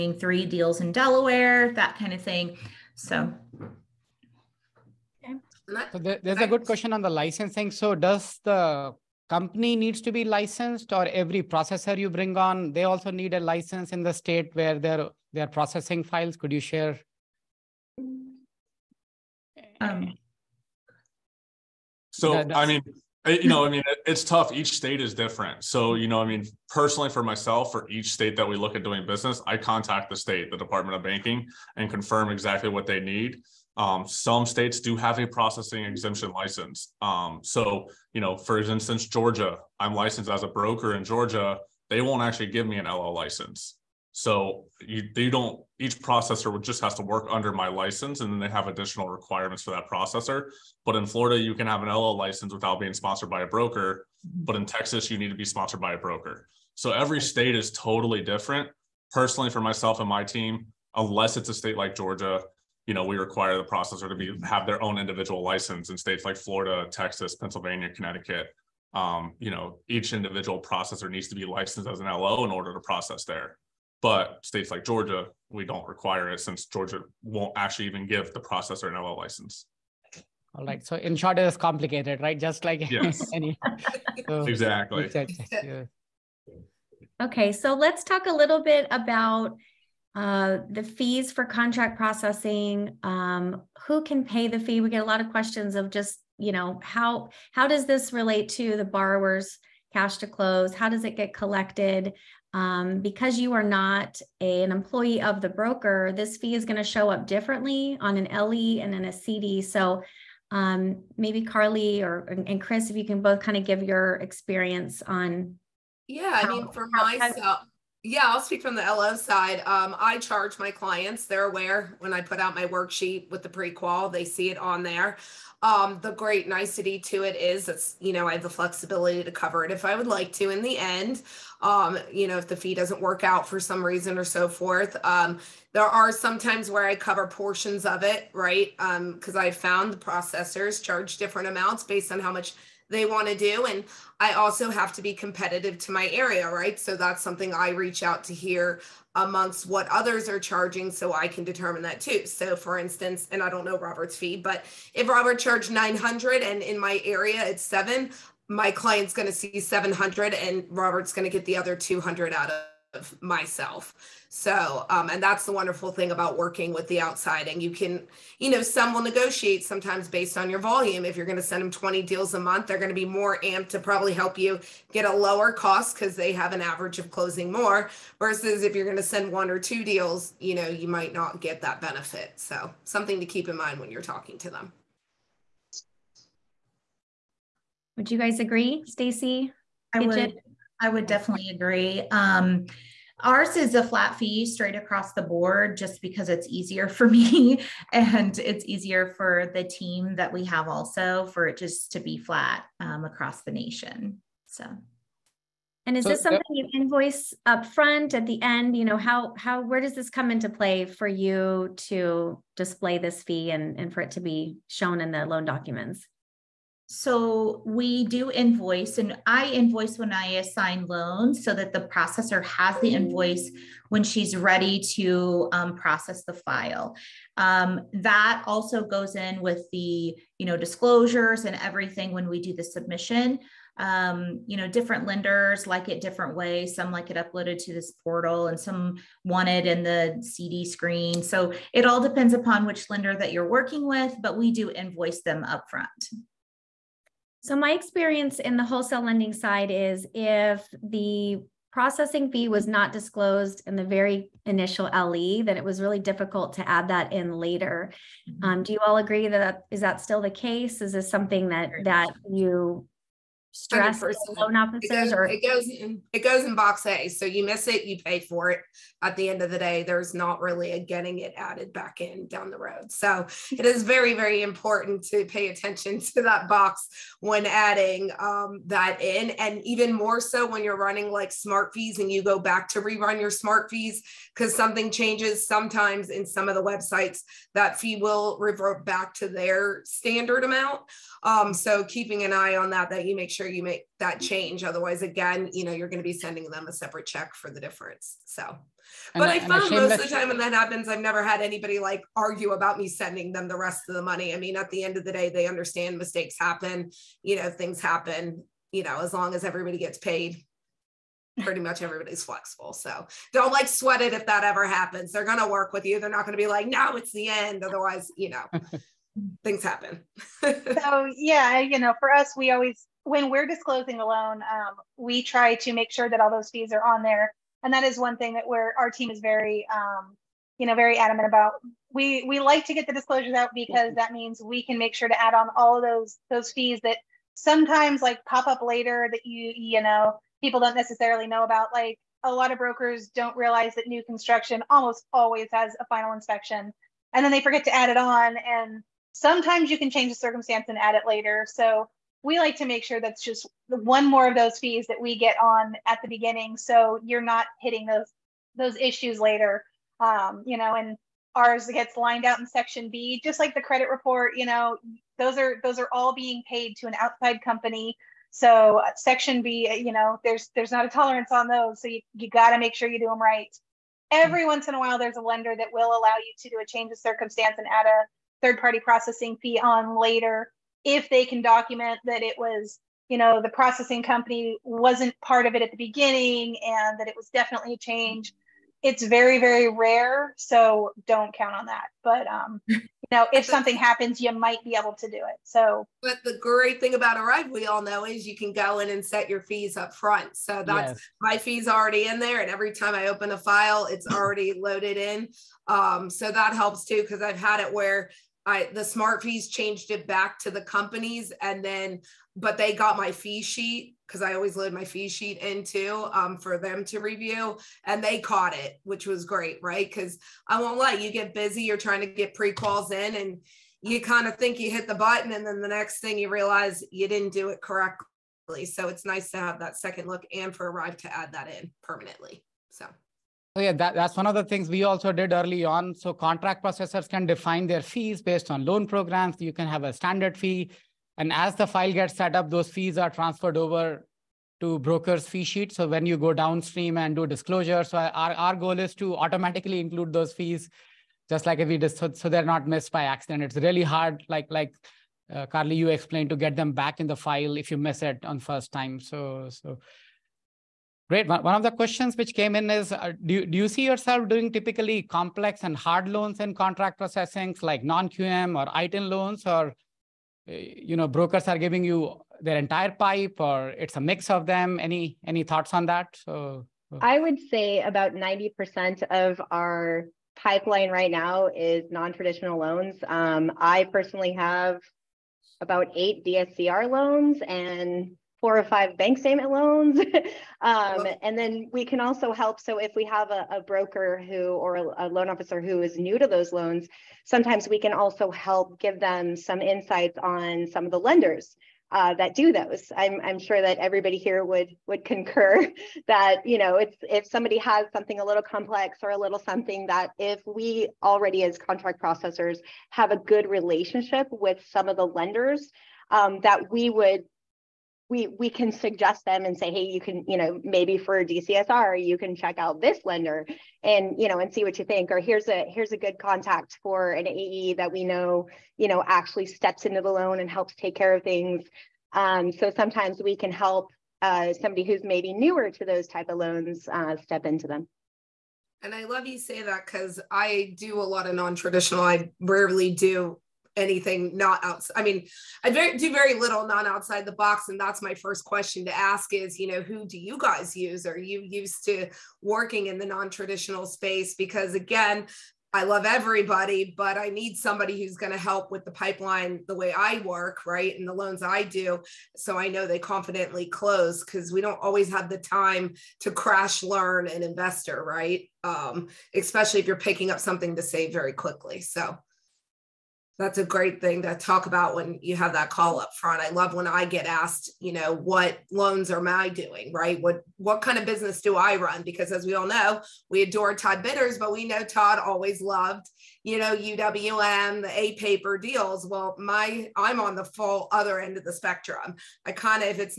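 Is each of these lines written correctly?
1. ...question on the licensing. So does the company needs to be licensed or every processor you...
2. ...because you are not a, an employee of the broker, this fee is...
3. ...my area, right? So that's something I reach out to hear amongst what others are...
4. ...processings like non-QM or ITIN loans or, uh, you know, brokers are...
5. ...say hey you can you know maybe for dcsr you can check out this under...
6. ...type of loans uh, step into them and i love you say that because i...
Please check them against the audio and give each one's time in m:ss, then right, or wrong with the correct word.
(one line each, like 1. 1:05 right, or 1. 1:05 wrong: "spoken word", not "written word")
1. 0:06 right
2. 1:42 right
3. 2:25 right
4. 7:46 right
5. 8:39 wrong: "lender", not "under"
6. 8:56 right.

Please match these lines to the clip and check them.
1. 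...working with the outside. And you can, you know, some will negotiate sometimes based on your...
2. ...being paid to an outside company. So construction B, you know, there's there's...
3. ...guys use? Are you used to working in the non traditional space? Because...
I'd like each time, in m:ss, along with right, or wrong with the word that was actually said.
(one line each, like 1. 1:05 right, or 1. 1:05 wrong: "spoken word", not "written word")
1. 2:46 right
2. 6:06 wrong: "section", not "construction"
3. 9:10 right.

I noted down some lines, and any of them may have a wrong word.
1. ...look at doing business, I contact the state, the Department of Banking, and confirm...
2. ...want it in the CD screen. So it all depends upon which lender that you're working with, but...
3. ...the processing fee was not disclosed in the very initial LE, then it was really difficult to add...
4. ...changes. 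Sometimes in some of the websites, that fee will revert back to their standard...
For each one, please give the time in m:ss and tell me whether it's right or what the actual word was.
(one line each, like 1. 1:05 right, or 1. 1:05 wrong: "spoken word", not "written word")
1. 0:28 right
2. 3:59 right
3. 4:10 right
4. 4:44 right.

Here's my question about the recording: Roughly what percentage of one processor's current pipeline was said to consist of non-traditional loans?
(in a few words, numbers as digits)
90%.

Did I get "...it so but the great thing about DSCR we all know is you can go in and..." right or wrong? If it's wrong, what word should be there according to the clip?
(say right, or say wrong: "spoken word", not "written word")
wrong: "ARIVE", not "DSCR".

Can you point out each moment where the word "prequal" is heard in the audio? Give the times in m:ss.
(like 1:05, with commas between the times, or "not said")
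2:03.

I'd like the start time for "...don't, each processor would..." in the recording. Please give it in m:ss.
0:45.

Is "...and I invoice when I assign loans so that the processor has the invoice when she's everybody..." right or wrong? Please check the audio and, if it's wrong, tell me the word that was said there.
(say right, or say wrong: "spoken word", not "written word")
wrong: "ready", not "everybody".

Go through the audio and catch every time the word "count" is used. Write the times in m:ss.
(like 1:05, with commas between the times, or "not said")
6:31.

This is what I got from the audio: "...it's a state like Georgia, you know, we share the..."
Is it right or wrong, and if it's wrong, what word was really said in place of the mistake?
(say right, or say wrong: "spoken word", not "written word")
wrong: "require", not "share".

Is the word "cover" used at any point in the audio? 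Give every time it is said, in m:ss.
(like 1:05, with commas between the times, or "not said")
2:09, 2:16.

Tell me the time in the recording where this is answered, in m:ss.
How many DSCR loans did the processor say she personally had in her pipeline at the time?
8:05.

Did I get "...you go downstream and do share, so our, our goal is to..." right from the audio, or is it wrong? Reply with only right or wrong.
wrong.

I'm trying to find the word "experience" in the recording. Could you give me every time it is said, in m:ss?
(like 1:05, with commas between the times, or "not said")
1:54, 4:07.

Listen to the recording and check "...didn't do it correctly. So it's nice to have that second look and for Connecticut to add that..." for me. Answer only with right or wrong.
wrong.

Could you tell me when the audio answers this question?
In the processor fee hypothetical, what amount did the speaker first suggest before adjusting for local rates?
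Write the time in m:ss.
2:35.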